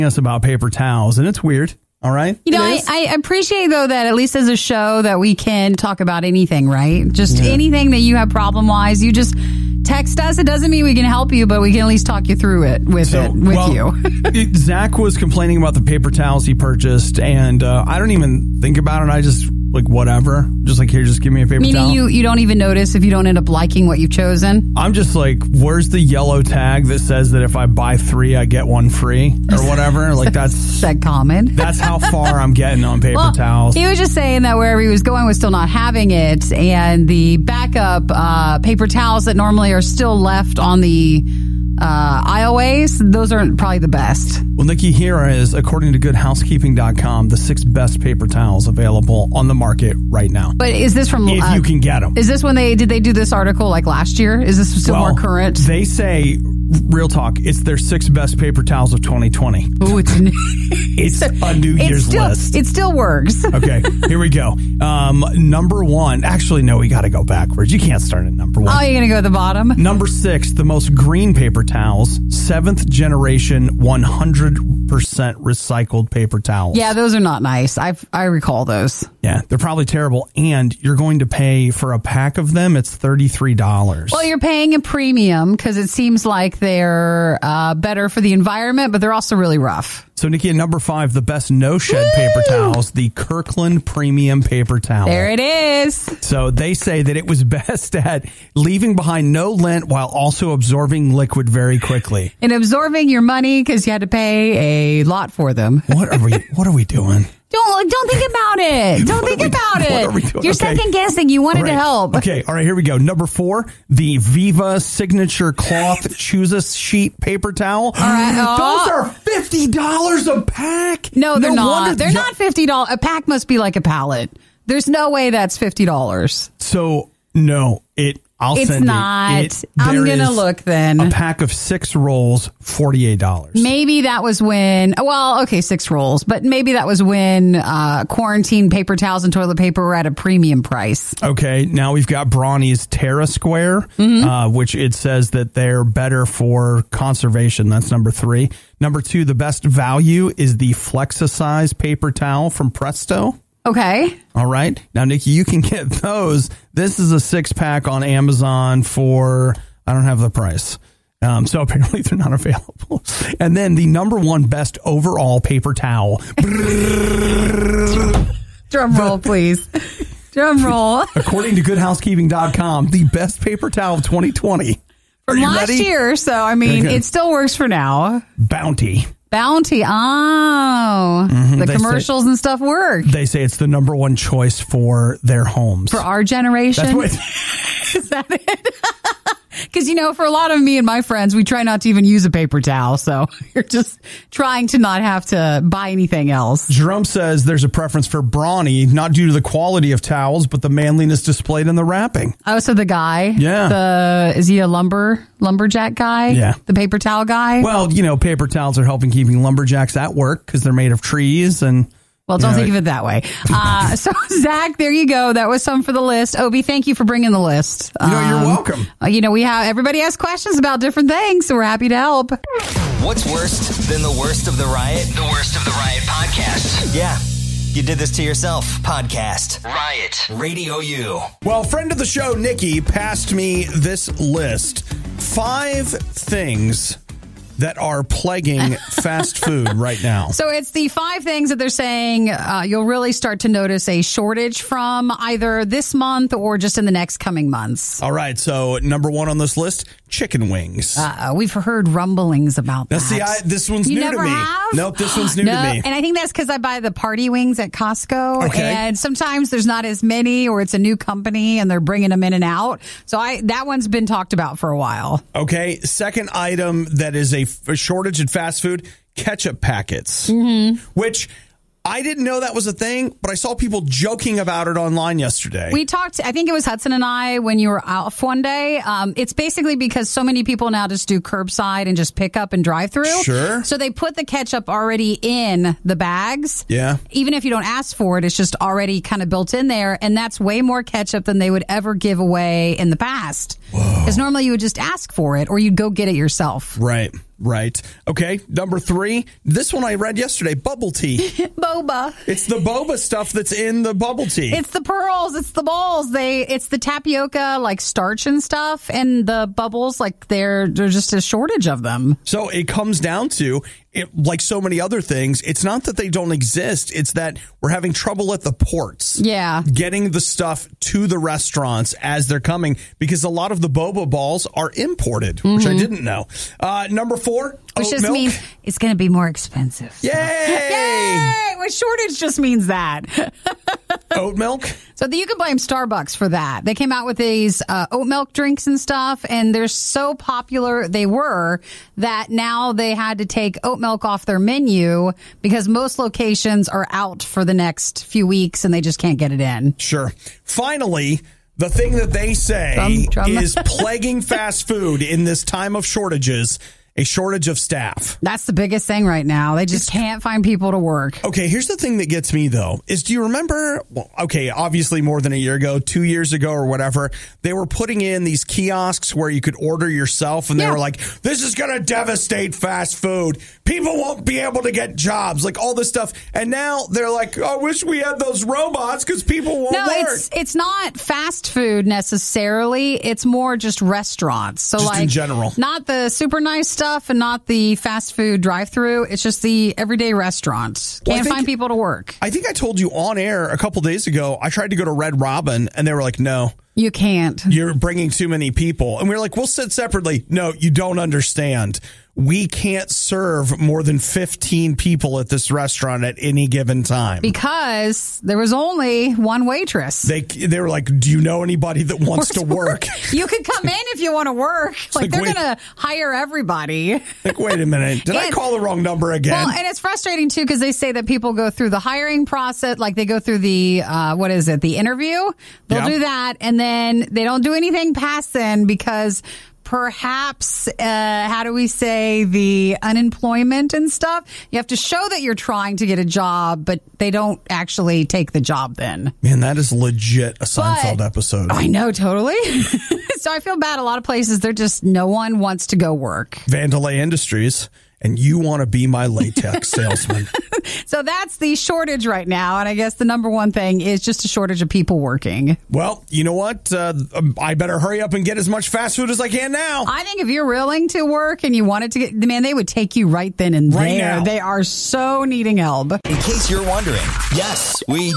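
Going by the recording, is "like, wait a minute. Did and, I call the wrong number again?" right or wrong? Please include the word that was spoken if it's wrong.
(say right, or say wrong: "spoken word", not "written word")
right.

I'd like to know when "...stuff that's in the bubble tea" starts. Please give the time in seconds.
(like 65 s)
302 s.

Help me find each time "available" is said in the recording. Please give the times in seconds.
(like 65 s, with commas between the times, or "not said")
48 s, 162 s.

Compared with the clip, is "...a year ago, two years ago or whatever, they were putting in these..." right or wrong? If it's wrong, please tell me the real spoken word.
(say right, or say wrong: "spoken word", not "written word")
right.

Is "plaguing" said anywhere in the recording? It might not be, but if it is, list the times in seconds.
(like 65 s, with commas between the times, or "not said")
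238 s, 353 s.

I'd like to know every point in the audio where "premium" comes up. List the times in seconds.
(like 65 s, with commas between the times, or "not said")
84 s, 93 s, 140 s.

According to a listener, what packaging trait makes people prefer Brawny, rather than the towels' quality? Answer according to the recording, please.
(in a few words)
Manliness.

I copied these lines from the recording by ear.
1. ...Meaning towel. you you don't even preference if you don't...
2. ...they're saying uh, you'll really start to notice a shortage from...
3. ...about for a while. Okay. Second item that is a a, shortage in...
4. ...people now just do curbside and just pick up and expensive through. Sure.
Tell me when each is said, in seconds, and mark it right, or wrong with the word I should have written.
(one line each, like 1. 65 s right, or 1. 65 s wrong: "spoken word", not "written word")
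1. 21 s wrong: "notice", not "preference"
2. 241 s right
3. 264 s right
4. 280 s wrong: "drive", not "expensive".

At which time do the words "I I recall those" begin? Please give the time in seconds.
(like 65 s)
77 s.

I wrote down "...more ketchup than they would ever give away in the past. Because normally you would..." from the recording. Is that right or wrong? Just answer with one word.
right.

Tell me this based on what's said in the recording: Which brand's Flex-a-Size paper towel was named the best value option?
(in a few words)
Presto.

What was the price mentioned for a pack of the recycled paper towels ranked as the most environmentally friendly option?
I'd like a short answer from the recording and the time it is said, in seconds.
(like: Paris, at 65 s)
$33, at 82 s.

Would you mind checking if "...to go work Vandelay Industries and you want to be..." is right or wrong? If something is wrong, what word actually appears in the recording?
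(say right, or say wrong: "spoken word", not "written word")
right.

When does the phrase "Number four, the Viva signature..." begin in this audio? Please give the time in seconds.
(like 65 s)
112 s.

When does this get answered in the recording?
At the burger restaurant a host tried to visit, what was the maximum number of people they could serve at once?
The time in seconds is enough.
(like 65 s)
403 s.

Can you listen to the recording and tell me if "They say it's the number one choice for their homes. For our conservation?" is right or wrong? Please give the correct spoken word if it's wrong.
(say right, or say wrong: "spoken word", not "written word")
wrong: "generation", not "conservation".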